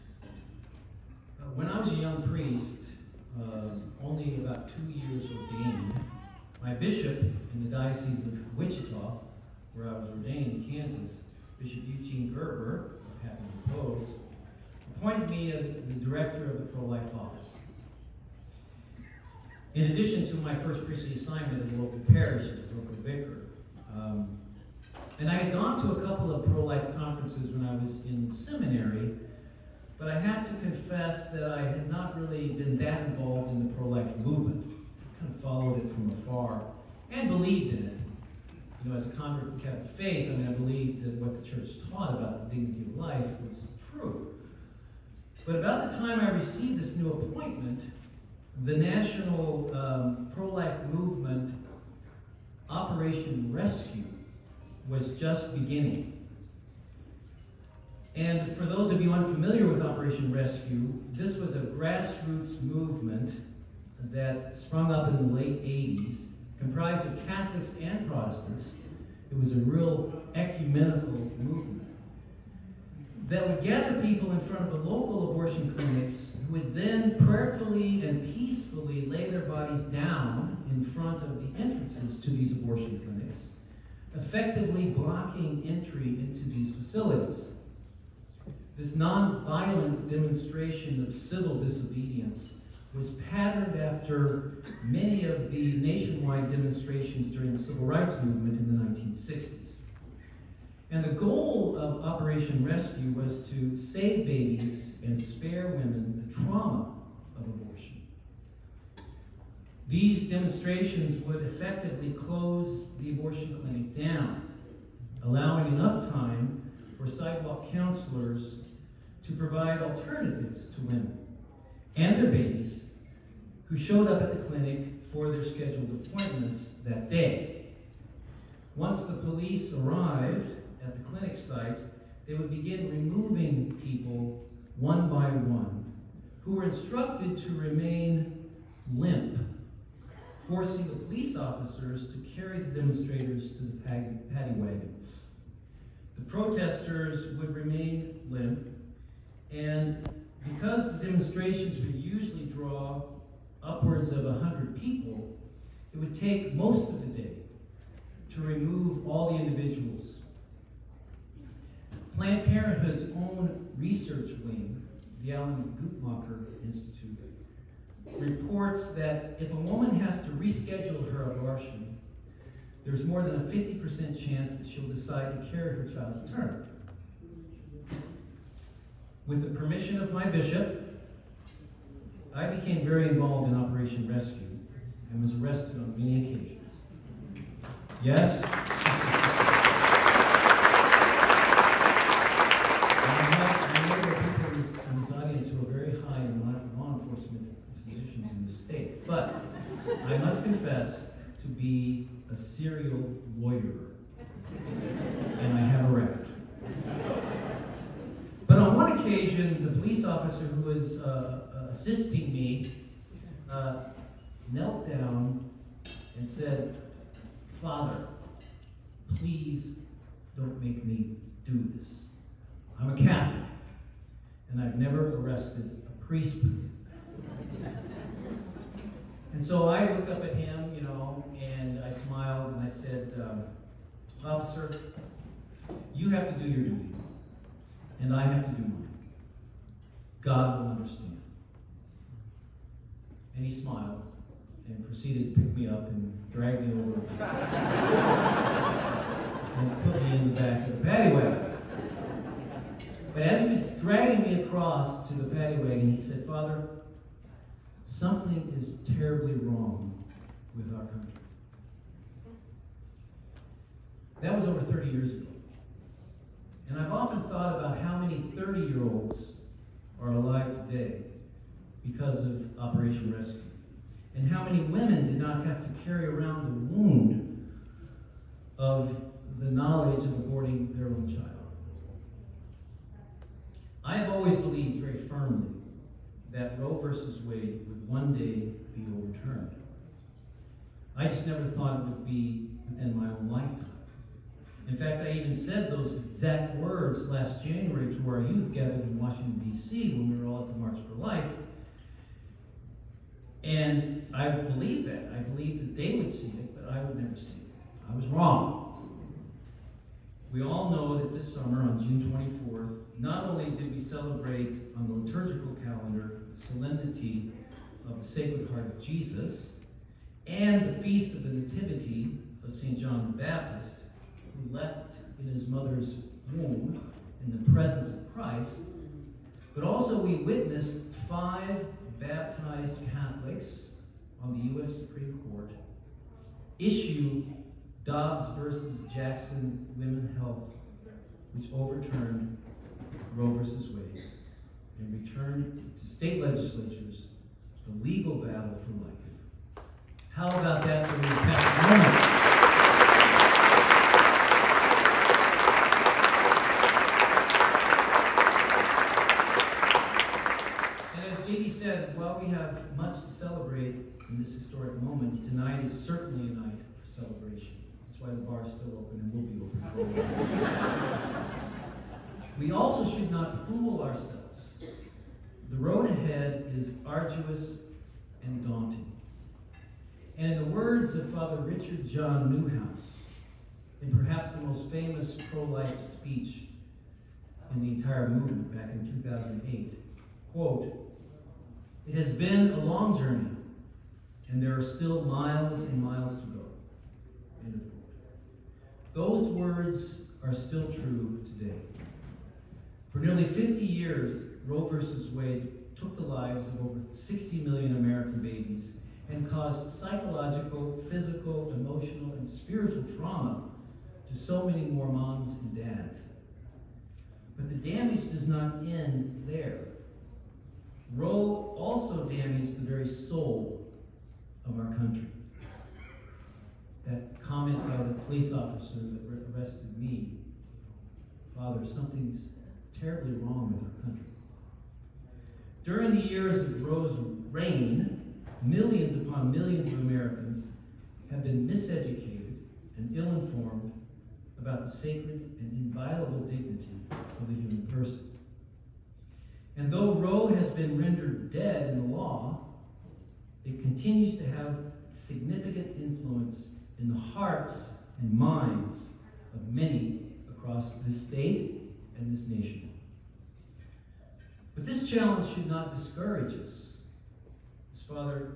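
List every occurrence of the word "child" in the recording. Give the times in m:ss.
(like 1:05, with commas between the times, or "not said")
2:55, 4:41.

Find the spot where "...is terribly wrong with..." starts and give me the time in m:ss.
4:18.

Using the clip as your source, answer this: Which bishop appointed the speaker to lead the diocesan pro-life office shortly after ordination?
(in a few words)
Eugene Gerber.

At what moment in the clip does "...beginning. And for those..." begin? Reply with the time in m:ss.
0:55.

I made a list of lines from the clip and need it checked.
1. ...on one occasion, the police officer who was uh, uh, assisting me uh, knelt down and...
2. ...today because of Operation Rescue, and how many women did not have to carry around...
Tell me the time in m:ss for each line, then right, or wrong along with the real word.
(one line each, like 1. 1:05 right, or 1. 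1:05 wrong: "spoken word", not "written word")
1. 3:28 right
2. 4:30 right.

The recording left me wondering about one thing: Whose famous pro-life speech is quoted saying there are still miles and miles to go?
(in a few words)
Richard John Neuhaus.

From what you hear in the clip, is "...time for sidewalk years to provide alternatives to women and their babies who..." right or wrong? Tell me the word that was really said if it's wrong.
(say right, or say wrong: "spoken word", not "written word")
wrong: "counselors", not "years".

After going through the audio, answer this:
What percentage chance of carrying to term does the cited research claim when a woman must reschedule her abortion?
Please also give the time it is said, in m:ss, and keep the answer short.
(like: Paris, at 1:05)
more than 50%, at 2:53.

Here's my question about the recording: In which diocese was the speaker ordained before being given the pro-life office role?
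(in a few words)
Wichita.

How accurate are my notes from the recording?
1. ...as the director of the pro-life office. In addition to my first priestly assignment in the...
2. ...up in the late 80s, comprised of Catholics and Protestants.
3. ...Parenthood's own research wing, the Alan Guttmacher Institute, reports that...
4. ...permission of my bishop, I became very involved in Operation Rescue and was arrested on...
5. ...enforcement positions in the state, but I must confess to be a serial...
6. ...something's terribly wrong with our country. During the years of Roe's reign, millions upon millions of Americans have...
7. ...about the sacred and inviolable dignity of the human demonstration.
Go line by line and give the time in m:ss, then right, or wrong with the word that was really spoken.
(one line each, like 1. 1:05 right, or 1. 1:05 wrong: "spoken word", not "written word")
1. 0:15 right
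2. 1:04 right
3. 2:42 right
4. 2:59 right
5. 3:16 right
6. 7:11 right
7. 7:24 wrong: "person", not "demonstration".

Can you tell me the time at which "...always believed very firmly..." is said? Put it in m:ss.
4:44.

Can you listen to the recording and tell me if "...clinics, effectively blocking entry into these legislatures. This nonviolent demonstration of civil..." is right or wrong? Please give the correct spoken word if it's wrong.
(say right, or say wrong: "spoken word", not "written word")
wrong: "facilities", not "legislatures".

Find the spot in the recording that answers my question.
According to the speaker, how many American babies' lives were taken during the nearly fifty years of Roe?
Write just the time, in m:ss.
6:46.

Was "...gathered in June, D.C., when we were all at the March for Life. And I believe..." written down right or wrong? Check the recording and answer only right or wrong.
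wrong.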